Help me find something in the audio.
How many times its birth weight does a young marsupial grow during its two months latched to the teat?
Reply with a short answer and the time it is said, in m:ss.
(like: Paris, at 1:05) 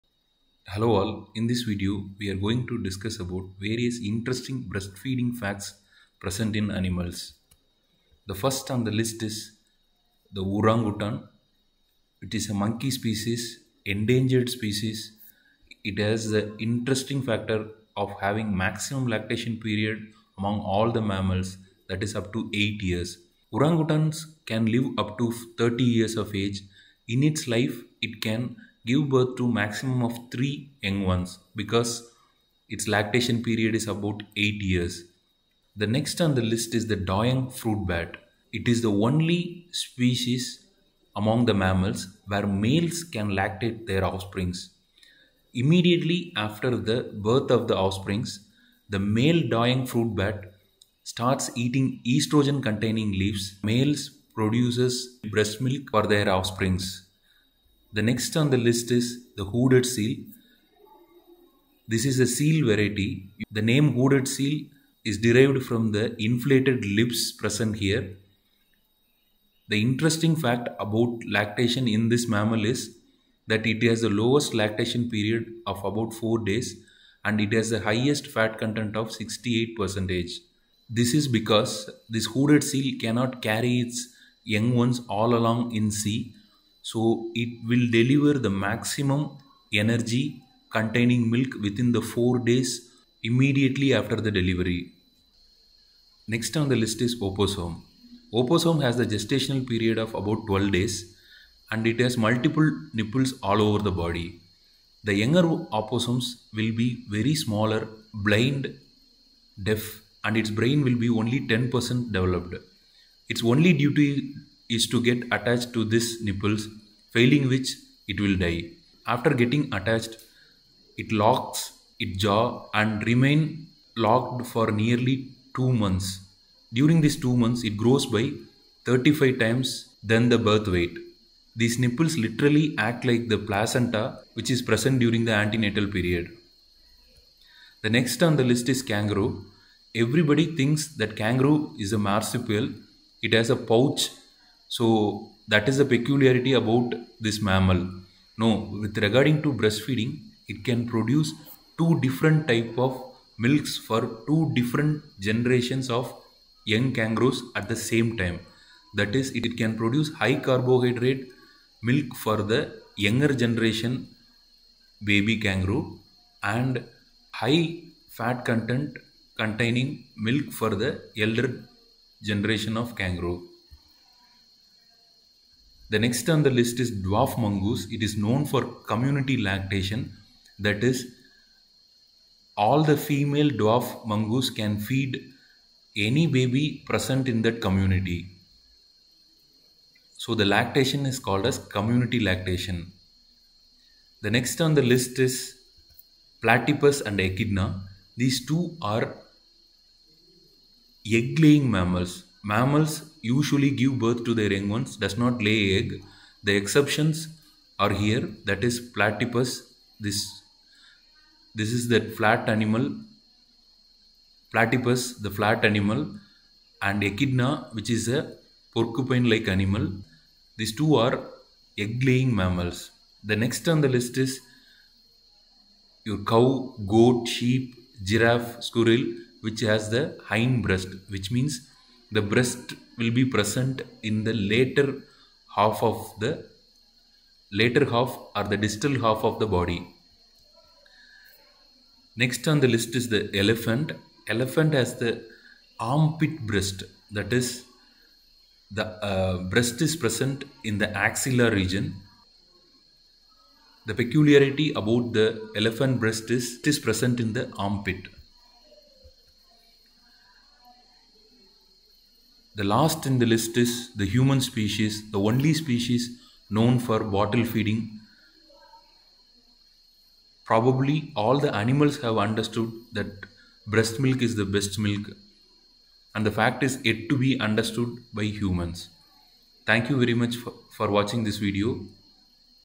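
35 times, at 2:08.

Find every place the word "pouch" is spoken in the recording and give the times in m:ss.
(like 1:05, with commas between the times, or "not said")
2:23.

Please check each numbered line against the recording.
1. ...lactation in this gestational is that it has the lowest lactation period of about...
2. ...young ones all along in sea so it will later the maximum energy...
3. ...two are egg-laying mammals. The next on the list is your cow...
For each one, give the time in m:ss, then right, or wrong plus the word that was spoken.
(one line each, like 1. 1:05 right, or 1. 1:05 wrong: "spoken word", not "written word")
1. 1:11 wrong: "mammal", not "gestational"
2. 1:24 wrong: "deliver", not "later"
3. 3:40 right.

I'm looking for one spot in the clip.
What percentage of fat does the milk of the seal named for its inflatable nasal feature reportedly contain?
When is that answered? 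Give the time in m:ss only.
1:19.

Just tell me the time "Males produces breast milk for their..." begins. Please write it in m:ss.
0:53.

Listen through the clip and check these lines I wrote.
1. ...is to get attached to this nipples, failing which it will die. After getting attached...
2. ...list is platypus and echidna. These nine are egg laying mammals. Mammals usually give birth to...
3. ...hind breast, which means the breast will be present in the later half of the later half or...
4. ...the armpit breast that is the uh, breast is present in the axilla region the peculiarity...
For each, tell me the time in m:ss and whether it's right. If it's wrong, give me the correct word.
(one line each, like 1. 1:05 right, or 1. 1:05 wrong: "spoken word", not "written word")
1. 1:54 right
2. 3:14 wrong: "two", not "nine"
3. 3:50 right
4. 4:05 right.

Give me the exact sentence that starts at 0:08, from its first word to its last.
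The first on the list is the orangutan.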